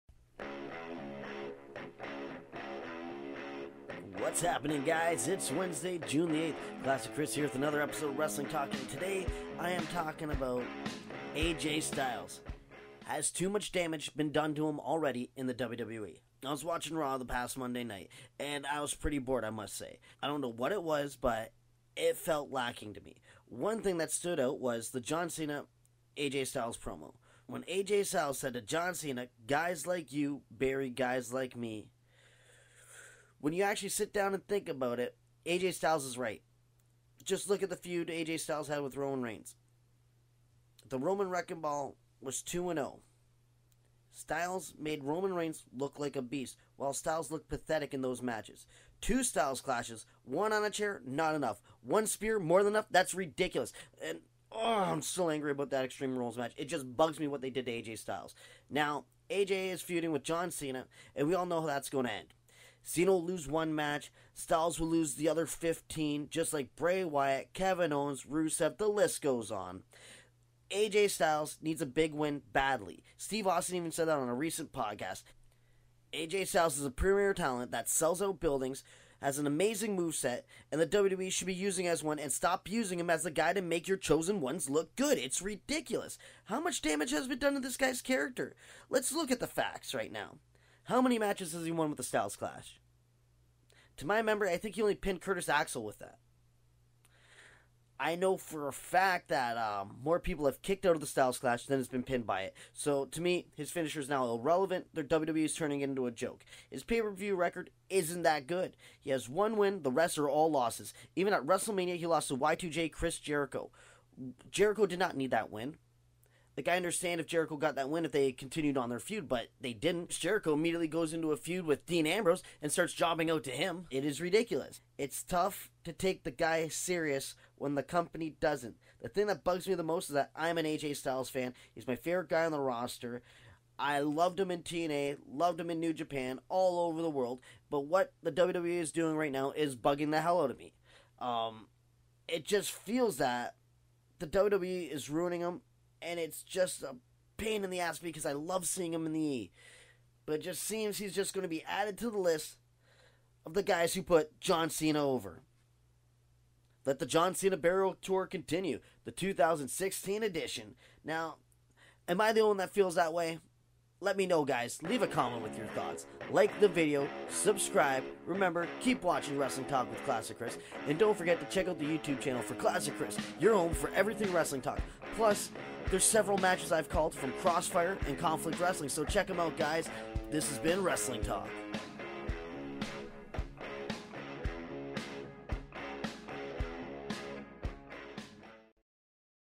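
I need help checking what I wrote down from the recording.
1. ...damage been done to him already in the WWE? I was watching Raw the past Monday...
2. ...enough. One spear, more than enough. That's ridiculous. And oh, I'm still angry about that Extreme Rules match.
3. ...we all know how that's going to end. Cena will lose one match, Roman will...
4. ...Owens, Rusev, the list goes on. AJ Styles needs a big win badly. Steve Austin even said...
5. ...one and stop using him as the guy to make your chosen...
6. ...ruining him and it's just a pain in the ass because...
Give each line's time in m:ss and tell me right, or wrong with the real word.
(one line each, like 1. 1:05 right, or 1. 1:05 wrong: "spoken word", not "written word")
1. 0:13 right
2. 0:51 right
3. 1:01 wrong: "Styles", not "Roman"
4. 1:07 right
5. 1:22 right
6. 2:25 right.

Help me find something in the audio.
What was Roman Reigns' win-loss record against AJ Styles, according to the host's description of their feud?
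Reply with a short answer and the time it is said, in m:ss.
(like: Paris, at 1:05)
2 and 0, at 0:42.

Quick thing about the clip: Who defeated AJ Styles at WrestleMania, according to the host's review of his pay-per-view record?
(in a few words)
Chris Jericho.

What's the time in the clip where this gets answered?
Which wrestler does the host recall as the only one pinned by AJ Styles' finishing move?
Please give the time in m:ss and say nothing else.
1:35.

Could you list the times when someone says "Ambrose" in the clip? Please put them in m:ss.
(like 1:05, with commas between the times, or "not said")
2:02.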